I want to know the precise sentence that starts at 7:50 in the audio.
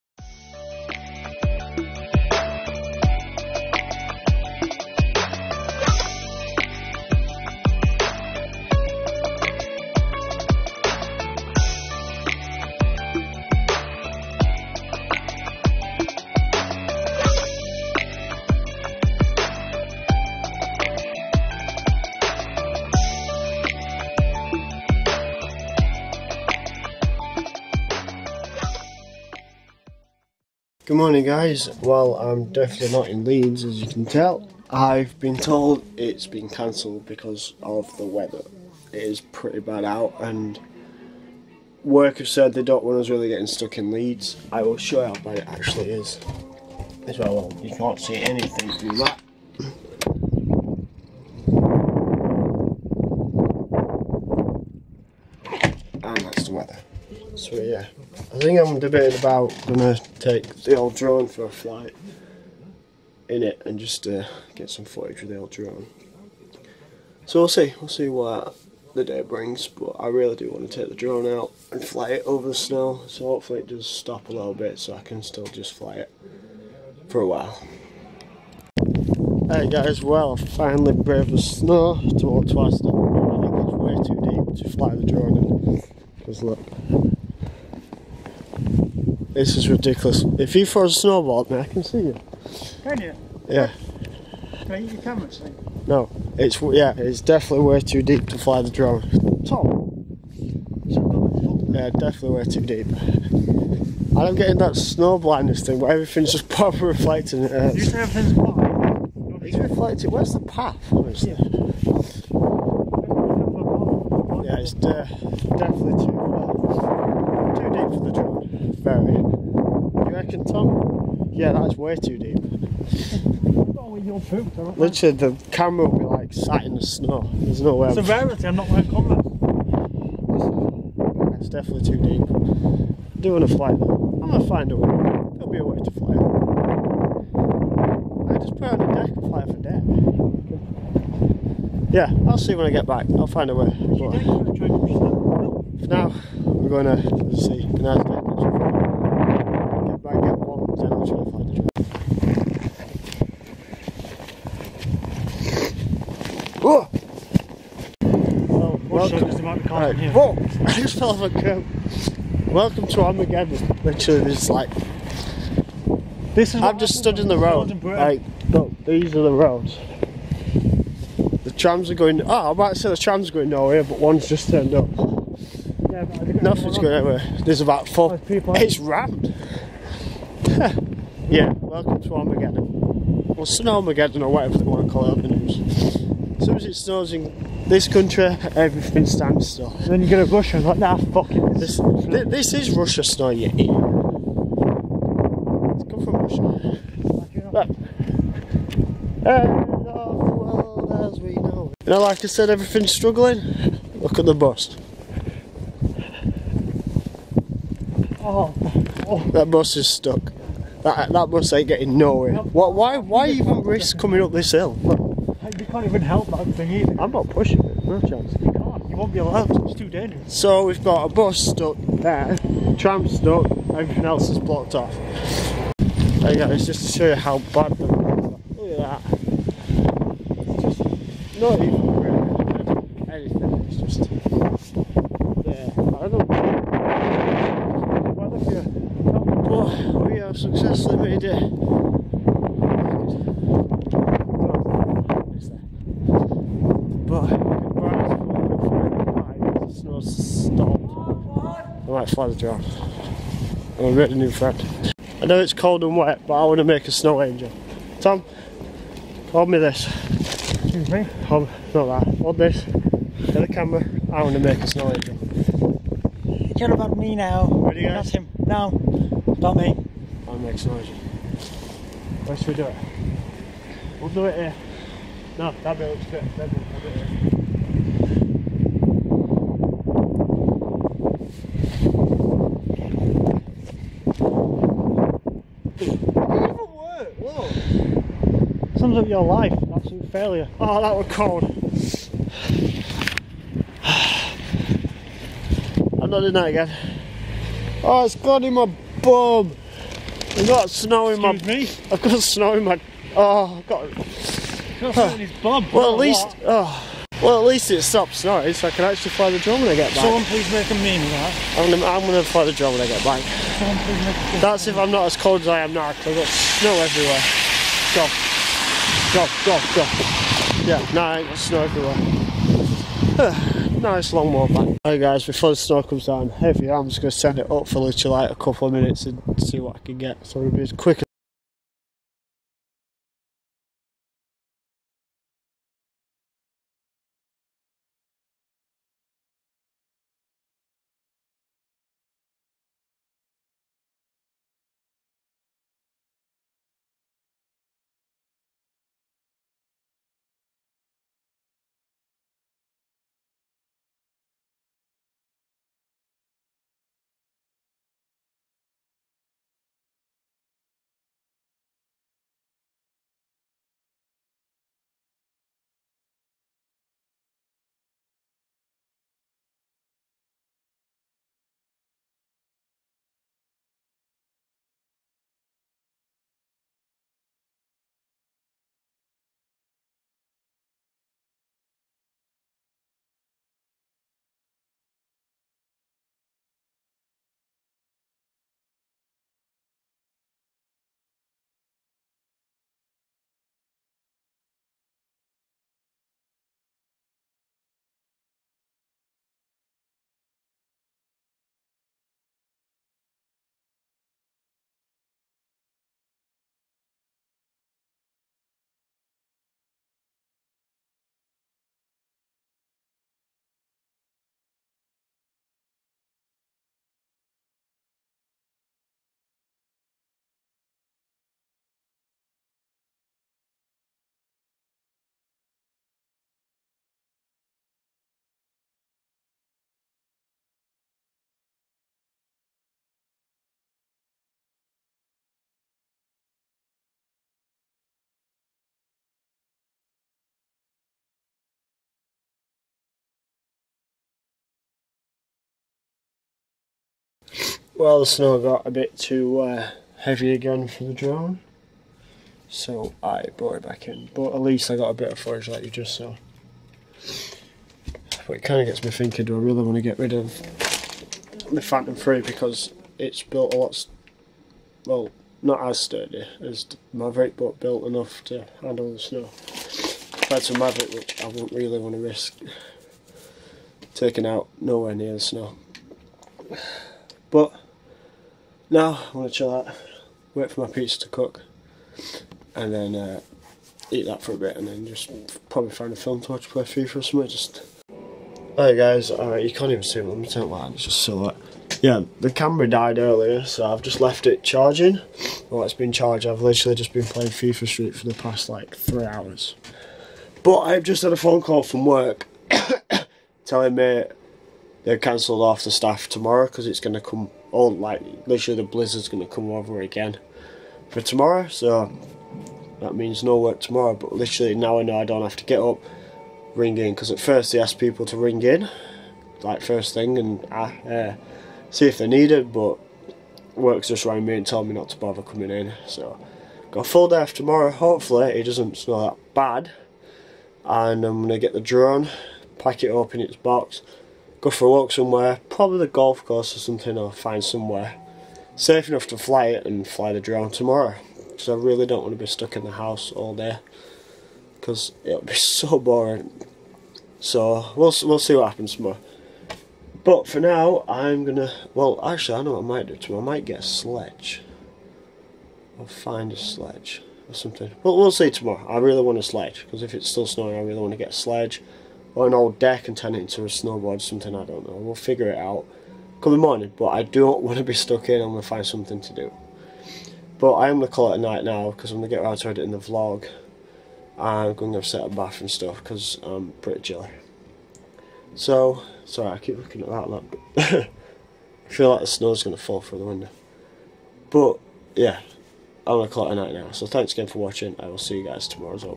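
Compared to Mavic, which I wouldn't really want to risk taking out nowhere near the snow.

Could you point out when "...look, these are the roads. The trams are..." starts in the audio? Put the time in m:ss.
2:48.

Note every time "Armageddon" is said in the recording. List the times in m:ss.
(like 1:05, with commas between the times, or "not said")
2:43, 3:02.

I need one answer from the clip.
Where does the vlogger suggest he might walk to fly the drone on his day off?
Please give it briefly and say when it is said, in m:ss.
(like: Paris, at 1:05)
The golf course, at 8:55.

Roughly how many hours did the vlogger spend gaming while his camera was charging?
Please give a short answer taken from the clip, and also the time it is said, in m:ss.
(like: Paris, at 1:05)
3, at 8:18.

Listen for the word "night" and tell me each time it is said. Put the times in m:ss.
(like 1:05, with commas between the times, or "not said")
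9:31, 9:46.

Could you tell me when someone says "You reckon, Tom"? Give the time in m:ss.
1:59.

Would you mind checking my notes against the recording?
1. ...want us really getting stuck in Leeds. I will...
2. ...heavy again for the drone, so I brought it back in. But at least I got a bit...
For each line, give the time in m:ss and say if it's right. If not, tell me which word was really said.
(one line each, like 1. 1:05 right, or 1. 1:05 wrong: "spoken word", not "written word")
1. 0:42 right
2. 7:29 right.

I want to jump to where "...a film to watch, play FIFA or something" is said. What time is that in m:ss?
8:05.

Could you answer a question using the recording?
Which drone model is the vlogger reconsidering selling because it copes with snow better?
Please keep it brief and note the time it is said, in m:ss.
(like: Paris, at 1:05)
Phantom 3, at 7:41.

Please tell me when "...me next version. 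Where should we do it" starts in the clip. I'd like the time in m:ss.
4:29.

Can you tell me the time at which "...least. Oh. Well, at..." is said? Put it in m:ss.
5:05.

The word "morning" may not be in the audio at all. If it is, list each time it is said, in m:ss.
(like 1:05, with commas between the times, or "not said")
0:30, 9:26.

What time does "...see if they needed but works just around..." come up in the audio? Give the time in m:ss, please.
8:41.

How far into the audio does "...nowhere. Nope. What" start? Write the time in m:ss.
3:31.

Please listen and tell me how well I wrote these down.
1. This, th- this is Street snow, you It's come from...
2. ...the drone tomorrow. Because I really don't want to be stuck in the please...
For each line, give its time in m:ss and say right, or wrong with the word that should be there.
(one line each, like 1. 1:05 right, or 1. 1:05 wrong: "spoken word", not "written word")
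1. 3:11 wrong: "Russia", not "Street"
2. 9:00 wrong: "house", not "please".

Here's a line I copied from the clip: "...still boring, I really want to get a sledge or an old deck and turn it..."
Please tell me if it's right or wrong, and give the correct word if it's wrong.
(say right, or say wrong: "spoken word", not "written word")
wrong: "snowing", not "boring".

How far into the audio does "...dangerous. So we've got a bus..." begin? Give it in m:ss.
3:39.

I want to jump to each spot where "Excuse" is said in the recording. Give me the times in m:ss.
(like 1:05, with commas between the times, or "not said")
4:20, 5:01.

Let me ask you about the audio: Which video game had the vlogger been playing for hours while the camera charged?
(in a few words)
FIFA Street.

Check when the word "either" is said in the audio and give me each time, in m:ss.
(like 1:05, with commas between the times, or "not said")
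3:36.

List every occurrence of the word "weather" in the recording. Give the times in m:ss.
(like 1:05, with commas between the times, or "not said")
0:38, 0:56.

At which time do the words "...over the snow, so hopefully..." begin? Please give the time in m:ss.
1:12.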